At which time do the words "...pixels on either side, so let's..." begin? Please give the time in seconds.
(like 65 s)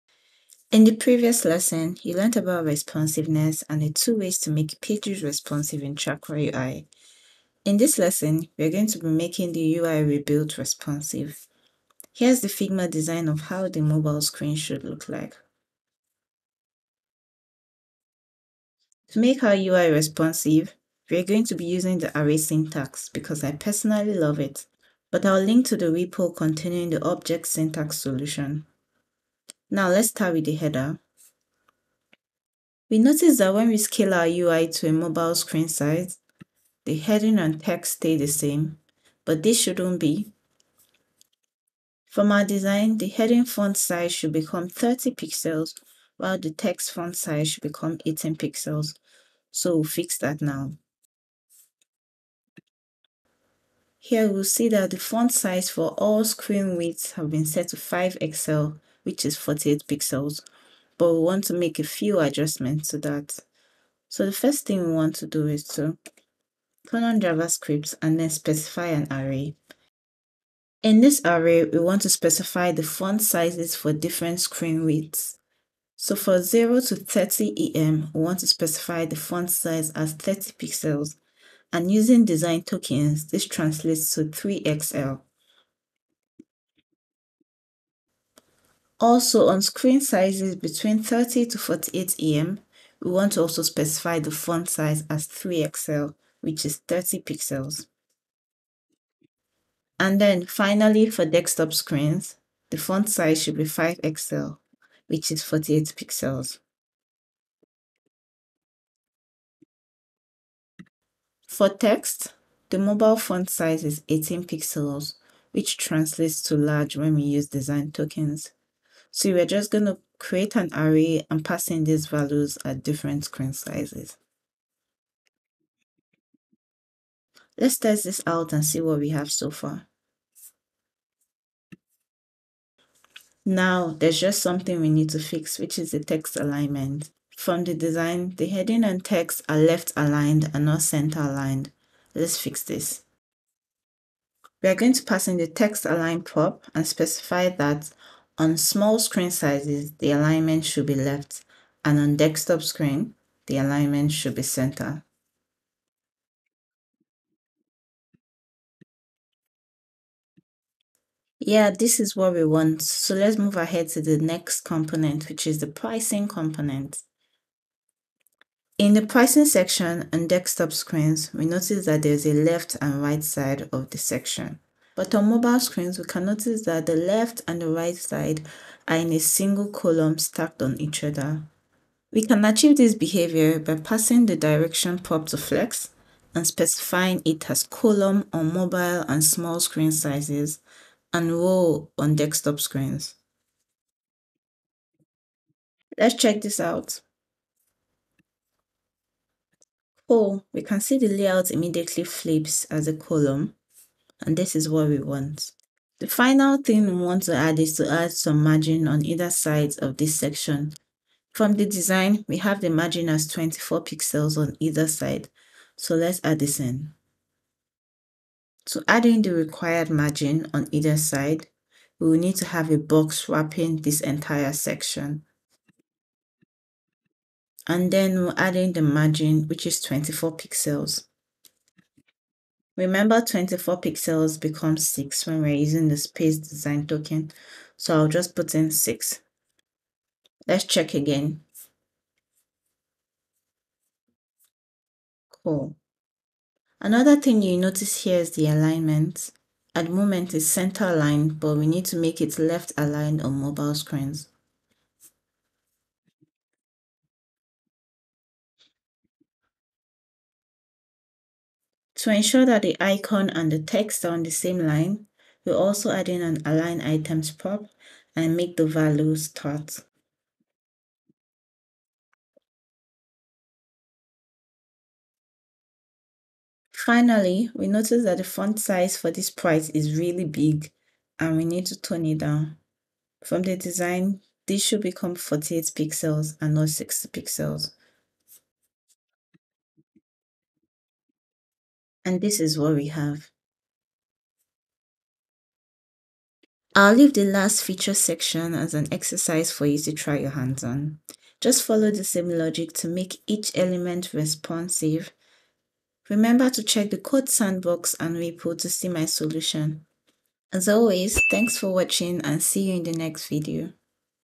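213 s.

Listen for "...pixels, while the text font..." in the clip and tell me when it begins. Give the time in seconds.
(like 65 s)
45 s.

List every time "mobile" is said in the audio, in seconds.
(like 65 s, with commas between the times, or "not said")
13 s, 34 s, 112 s, 175 s, 188 s, 253 s.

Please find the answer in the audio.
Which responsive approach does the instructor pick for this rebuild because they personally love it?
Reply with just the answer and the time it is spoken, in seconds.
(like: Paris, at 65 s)
array syntax, at 22 s.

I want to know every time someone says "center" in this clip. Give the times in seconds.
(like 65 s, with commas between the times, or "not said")
140 s, 154 s, 250 s.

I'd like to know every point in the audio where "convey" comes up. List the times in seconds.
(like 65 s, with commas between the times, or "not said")
not said.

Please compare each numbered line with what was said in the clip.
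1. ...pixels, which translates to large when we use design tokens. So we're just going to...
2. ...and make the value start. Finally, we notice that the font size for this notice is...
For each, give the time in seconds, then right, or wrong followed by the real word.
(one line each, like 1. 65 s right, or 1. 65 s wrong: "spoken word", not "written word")
1. 114 s right
2. 268 s wrong: "price", not "notice".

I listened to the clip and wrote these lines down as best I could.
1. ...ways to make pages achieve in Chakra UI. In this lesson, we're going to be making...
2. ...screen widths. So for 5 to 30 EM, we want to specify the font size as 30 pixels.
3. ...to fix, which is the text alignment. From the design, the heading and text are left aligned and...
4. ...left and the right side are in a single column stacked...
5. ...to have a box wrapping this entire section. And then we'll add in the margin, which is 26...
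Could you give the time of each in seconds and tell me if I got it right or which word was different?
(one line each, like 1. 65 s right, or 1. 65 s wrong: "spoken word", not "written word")
1. 4 s wrong: "responsive", not "achieve"
2. 74 s wrong: "0", not "5"
3. 135 s right
4. 176 s right
5. 222 s wrong: "24", not "26".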